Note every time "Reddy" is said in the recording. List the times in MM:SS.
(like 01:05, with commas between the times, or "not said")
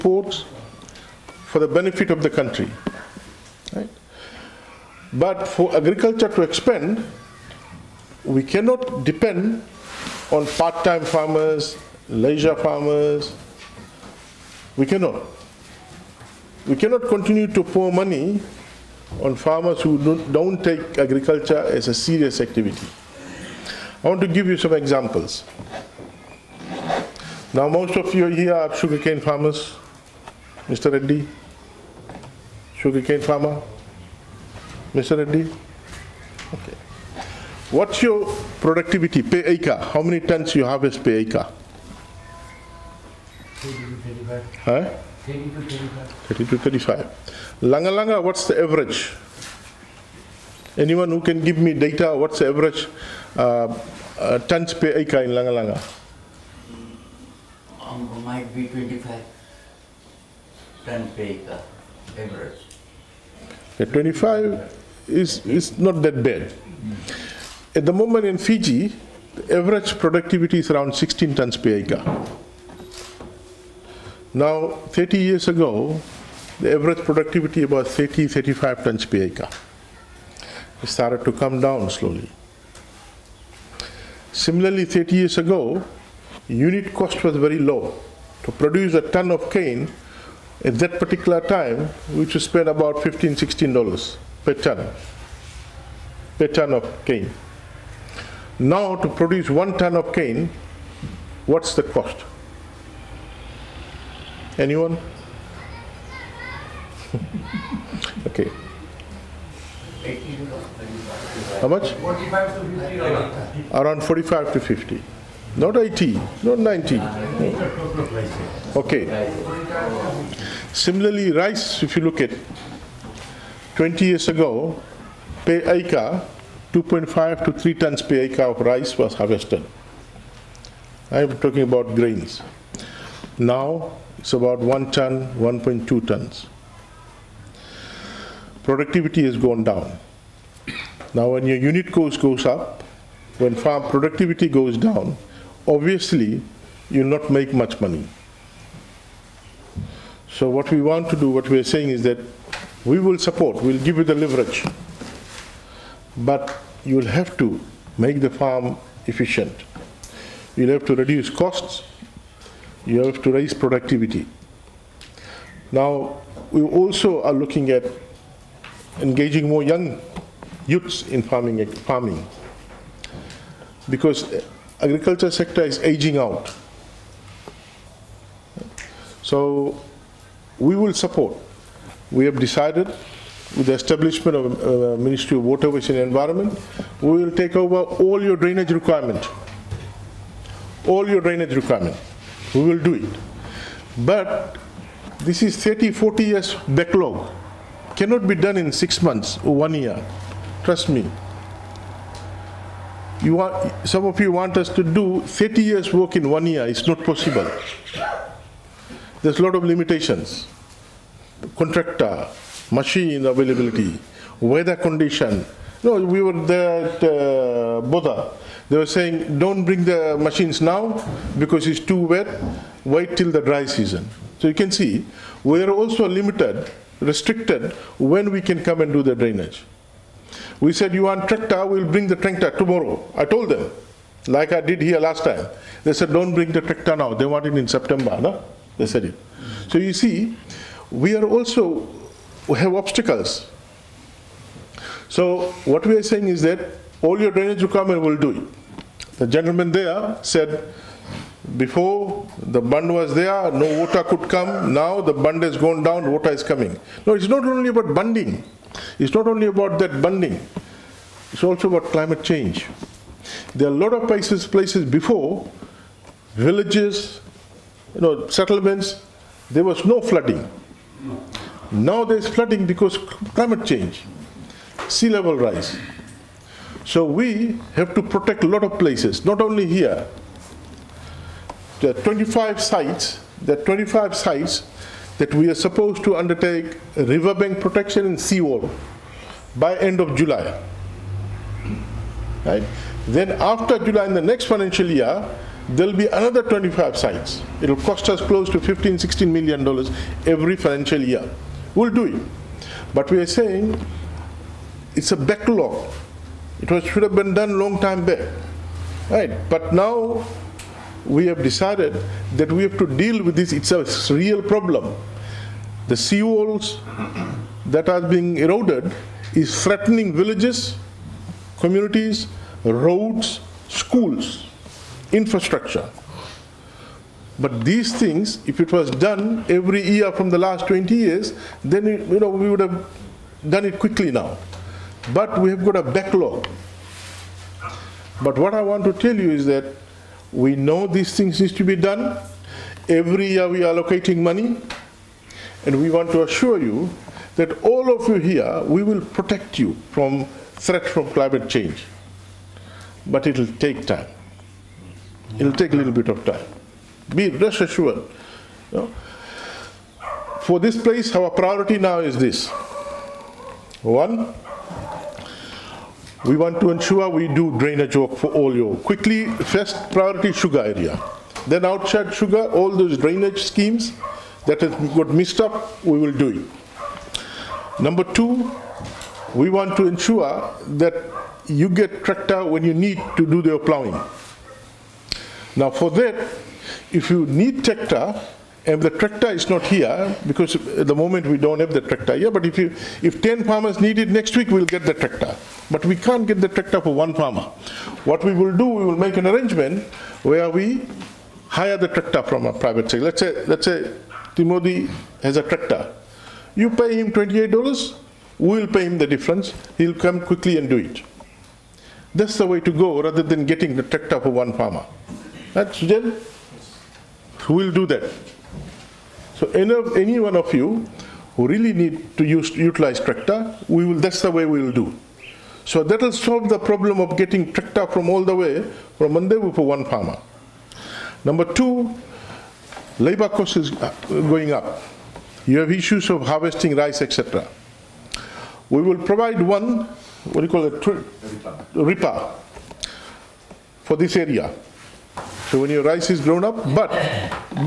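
00:30, 00:35.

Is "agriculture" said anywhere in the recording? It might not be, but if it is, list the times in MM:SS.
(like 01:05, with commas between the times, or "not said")
00:05, 00:20, 02:54.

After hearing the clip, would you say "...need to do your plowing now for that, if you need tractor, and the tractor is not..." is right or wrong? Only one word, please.
right.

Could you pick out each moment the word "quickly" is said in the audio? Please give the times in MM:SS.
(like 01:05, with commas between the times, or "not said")
05:33, 06:08, 06:50.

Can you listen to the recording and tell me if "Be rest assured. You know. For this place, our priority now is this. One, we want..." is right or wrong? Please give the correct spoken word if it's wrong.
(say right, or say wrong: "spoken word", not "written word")
right.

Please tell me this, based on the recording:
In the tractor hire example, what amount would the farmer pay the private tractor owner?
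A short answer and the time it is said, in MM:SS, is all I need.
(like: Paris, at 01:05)
$28, at 06:47.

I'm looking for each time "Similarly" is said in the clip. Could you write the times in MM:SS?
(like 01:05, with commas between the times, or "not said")
01:24, 02:00.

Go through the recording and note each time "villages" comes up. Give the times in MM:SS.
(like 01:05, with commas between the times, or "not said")
04:26, 05:20.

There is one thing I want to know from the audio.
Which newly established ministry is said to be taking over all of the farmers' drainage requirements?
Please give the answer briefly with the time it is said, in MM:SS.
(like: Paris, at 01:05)
Ministry of Water, Waste and Environment, at 03:05.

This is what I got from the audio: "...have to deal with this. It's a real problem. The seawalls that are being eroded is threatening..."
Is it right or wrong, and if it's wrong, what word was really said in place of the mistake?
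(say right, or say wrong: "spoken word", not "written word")
right.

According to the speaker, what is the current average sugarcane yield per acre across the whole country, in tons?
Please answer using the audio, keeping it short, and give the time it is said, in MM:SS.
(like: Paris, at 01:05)
16, at 01:10.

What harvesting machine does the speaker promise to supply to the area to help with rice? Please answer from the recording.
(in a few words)
Reaper.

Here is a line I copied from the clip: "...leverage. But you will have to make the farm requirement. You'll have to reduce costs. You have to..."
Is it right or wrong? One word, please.
wrong.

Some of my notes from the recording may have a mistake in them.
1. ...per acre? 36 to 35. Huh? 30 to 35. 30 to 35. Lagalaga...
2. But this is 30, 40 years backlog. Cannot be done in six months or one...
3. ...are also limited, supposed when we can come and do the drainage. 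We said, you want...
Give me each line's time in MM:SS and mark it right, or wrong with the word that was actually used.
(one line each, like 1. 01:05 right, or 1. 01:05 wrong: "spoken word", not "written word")
1. 00:41 wrong: "30", not "36"
2. 03:13 right
3. 03:45 wrong: "restricted", not "supposed".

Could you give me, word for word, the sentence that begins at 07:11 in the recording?
Number two, labor cost is uh, going up.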